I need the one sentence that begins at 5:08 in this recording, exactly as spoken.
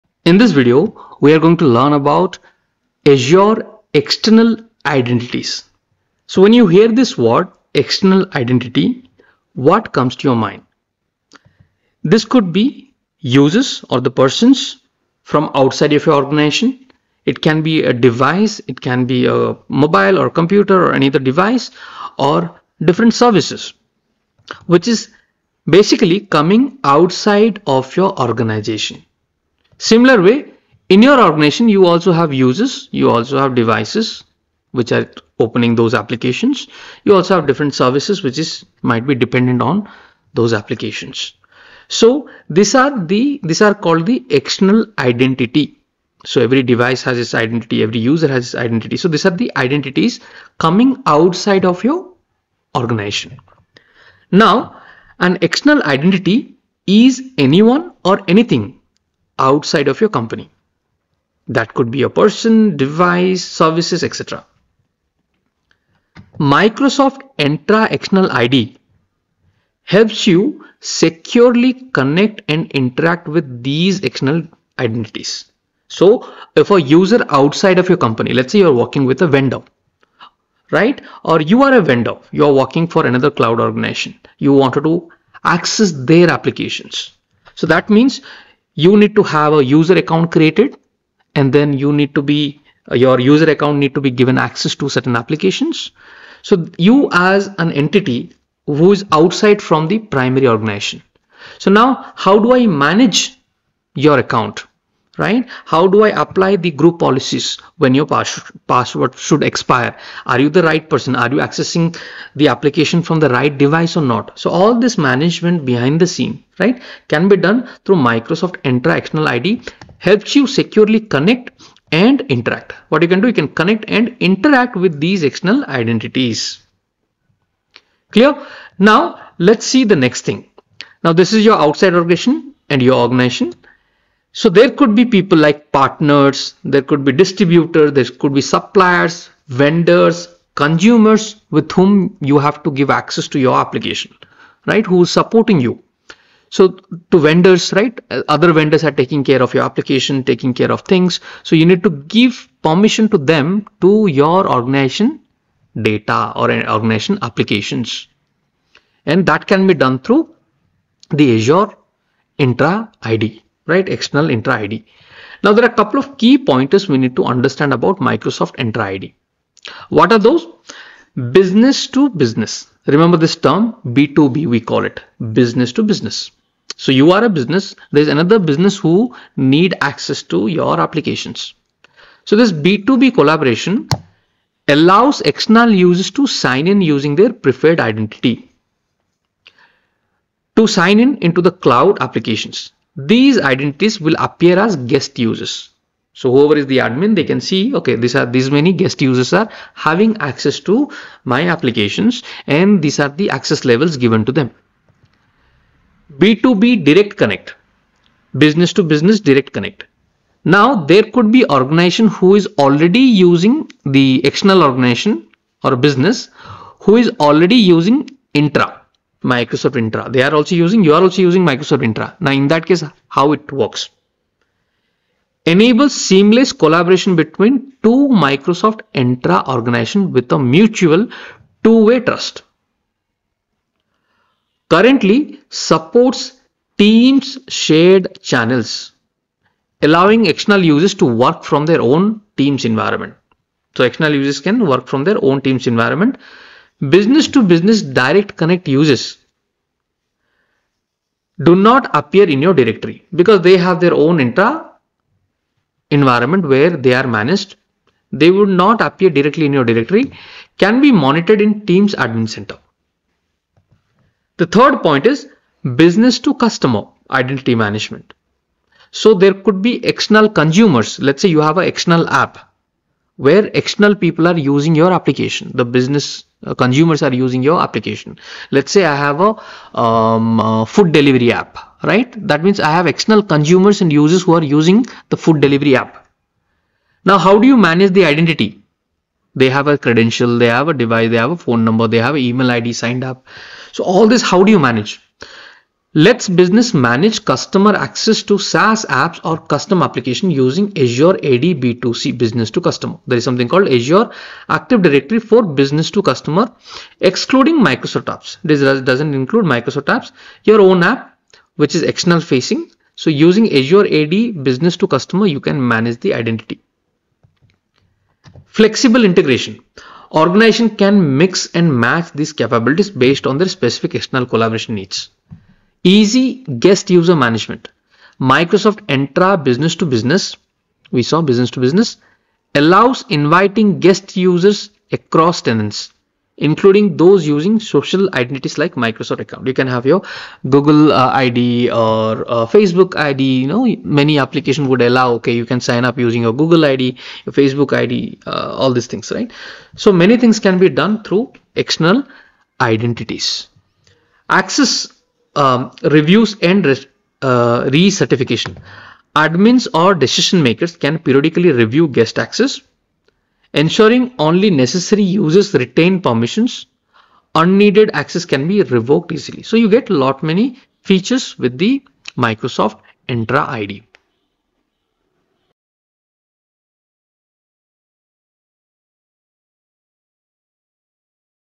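This doesn't include Microsoft apps, your own app, which is external facing.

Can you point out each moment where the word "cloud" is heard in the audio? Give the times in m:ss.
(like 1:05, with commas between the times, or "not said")
1:23, 3:11.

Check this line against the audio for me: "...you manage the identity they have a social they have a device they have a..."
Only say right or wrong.
wrong.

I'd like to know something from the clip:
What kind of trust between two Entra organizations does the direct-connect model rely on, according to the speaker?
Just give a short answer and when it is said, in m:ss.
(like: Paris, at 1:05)
mutual two-way trust, at 3:50.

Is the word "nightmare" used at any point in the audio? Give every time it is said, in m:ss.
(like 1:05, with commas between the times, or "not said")
not said.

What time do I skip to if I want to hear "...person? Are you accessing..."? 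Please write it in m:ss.
1:50.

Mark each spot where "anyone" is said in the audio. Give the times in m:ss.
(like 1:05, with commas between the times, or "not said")
0:57.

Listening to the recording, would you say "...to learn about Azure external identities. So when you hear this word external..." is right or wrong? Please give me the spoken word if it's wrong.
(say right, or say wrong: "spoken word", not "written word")
right.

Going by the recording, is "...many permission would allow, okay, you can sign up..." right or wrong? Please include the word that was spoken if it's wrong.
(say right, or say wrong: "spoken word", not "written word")
wrong: "application", not "permission".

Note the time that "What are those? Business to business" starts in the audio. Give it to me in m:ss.
2:49.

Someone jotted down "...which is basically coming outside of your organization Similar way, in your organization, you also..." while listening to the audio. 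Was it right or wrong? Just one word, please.
right.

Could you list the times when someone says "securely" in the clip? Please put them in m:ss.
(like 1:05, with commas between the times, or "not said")
1:10, 2:00.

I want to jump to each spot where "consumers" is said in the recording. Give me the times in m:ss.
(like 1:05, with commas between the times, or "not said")
2:20, 4:30, 4:36, 4:43.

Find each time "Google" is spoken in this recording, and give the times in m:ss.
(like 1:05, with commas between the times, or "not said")
5:40, 5:46.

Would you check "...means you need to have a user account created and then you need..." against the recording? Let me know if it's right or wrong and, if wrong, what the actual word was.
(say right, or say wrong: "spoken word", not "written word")
right.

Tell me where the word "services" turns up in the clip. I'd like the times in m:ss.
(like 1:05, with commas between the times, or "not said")
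0:23, 0:37, 1:03.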